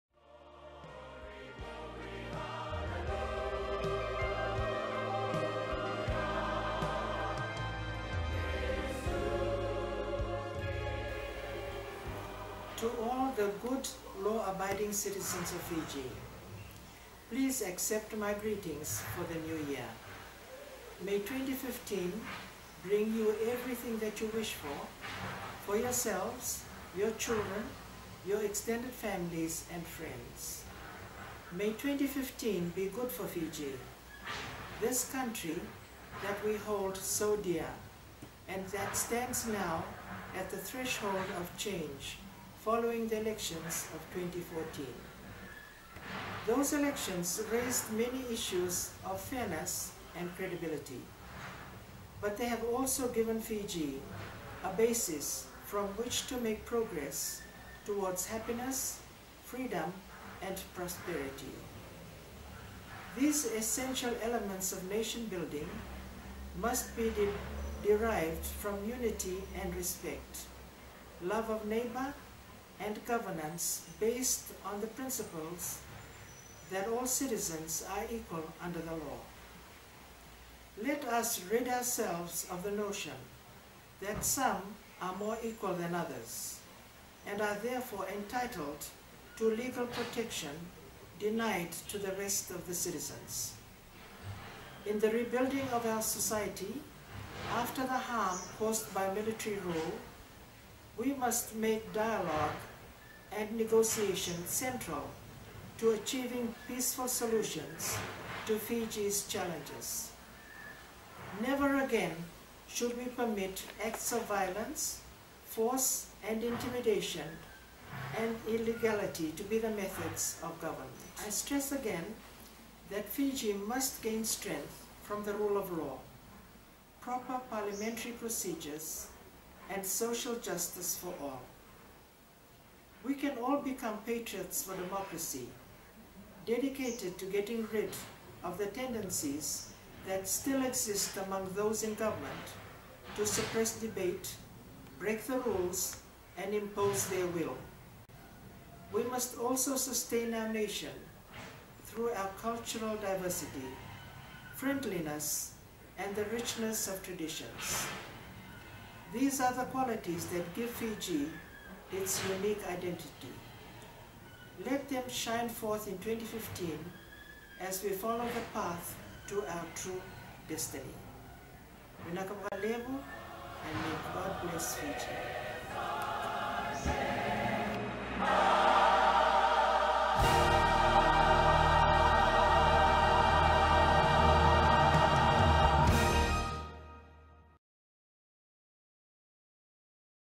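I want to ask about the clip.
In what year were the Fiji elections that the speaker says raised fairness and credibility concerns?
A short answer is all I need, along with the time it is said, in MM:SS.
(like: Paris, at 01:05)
2014, at 00:44.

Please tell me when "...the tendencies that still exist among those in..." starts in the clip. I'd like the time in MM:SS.
02:18.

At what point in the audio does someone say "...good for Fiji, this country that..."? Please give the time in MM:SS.
00:32.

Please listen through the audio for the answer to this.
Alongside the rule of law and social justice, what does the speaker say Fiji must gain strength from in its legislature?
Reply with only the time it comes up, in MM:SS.
02:06.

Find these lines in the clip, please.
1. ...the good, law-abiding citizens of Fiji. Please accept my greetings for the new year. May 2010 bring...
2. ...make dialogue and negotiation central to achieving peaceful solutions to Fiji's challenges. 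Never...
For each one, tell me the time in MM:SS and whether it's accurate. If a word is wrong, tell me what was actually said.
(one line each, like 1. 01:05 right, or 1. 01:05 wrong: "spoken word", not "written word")
1. 00:13 wrong: "2015", not "2010"
2. 01:41 right.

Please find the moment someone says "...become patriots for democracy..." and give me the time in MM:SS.
02:13.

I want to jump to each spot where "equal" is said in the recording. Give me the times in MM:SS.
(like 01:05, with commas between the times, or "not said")
01:18, 01:25.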